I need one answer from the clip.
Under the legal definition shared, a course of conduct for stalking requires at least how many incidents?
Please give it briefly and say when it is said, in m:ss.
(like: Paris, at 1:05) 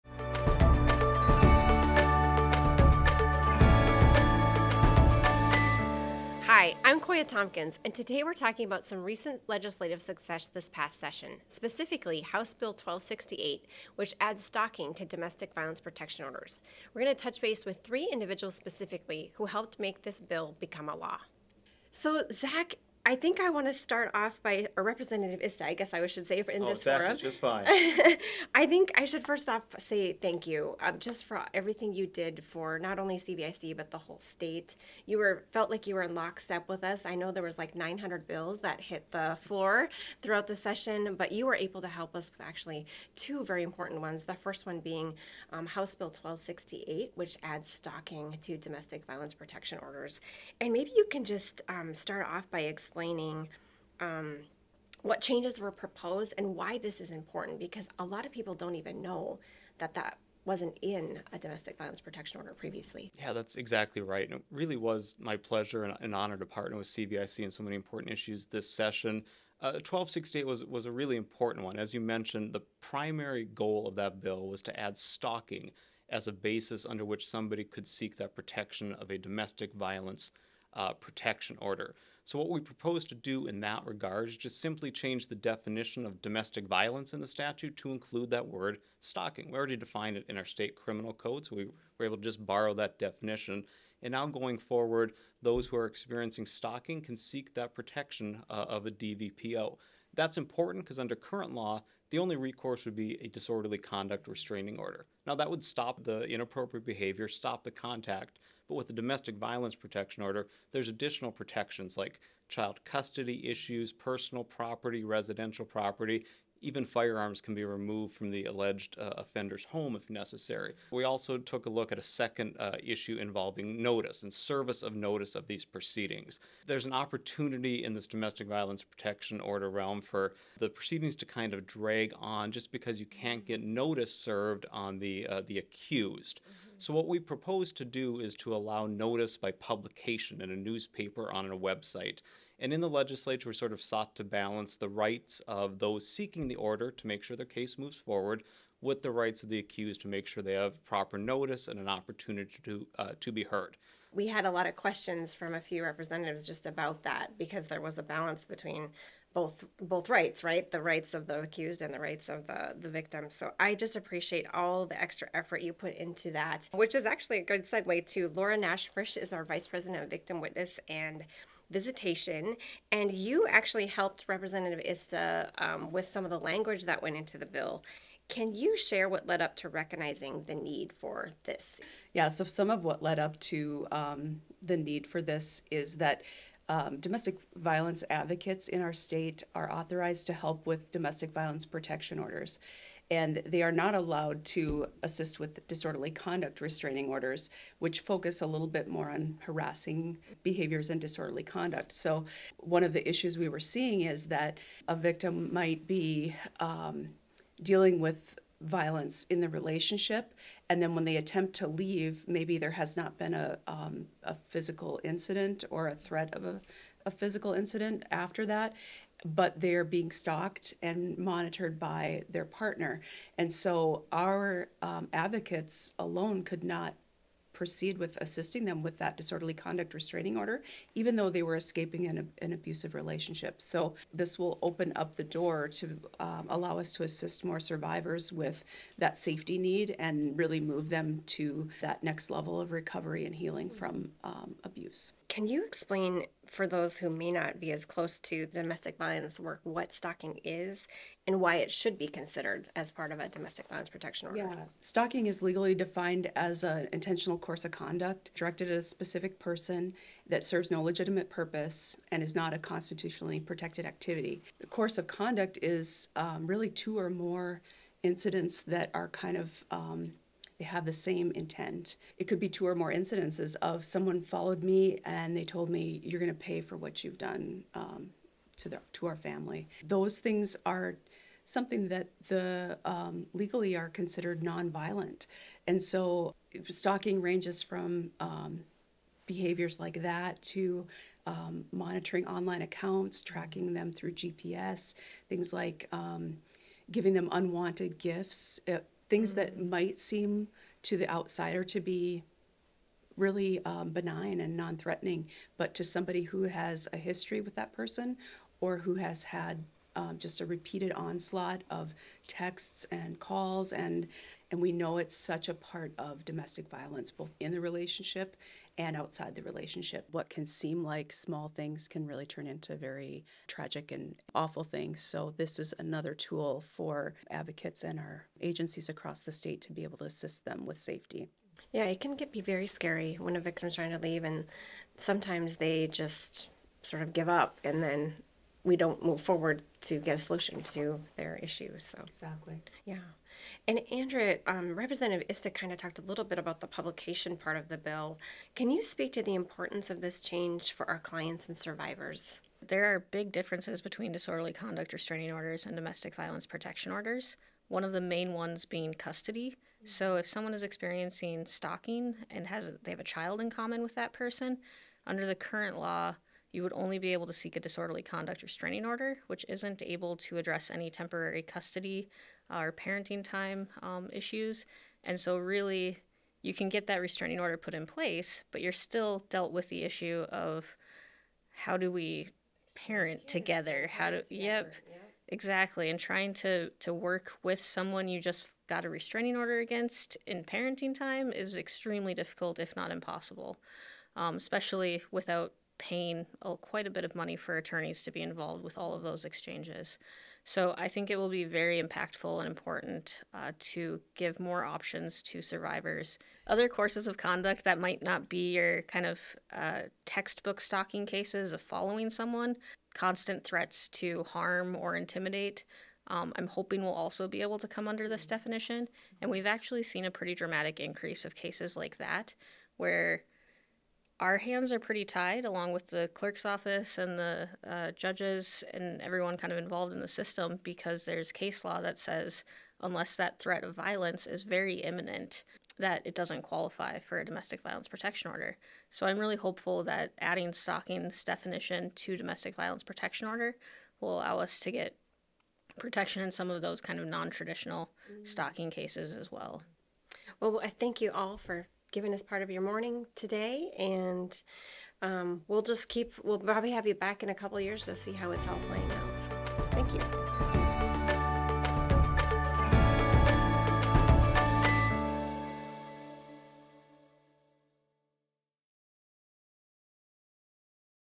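2, at 4:26.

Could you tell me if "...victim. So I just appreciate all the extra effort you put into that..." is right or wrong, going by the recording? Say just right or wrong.
right.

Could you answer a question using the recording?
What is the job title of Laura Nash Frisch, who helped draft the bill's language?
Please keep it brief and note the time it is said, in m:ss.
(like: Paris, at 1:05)
Vice president of victim witness and visitation, at 2:49.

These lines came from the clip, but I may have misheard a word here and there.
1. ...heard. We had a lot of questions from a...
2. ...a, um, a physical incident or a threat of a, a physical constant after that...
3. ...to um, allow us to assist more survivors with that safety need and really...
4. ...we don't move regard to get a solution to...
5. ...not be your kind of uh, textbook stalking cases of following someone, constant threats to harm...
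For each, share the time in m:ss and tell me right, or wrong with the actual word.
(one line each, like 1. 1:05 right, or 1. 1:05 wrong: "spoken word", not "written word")
1. 2:33 right
2. 3:33 wrong: "incident", not "constant"
3. 3:55 right
4. 5:38 wrong: "forward", not "regard"
5. 6:48 right.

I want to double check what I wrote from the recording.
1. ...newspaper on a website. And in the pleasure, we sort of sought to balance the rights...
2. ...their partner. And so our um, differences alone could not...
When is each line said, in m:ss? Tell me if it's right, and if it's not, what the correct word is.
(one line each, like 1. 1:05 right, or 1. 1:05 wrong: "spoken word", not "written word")
1. 2:20 wrong: "legislature", not "pleasure"
2. 3:42 wrong: "advocates", not "differences".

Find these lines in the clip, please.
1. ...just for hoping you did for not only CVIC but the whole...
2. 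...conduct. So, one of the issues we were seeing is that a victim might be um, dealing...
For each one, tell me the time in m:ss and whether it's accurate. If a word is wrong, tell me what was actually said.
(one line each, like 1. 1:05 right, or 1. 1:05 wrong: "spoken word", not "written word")
1. 0:30 wrong: "everything", not "hoping"
2. 3:21 right.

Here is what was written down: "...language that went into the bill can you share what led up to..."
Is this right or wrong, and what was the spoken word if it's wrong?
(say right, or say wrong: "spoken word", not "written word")
right.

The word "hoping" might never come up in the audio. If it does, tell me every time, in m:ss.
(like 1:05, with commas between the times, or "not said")
6:56.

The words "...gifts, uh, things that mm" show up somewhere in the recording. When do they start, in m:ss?
4:57.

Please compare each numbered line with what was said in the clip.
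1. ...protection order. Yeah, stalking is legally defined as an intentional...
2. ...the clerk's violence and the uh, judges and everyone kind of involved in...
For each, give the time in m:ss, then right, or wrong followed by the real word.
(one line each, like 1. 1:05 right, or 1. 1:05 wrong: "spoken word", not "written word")
1. 4:13 right
2. 7:05 wrong: "office", not "violence".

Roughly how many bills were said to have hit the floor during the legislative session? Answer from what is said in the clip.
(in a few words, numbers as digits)
900.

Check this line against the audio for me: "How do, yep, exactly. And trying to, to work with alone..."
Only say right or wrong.
wrong.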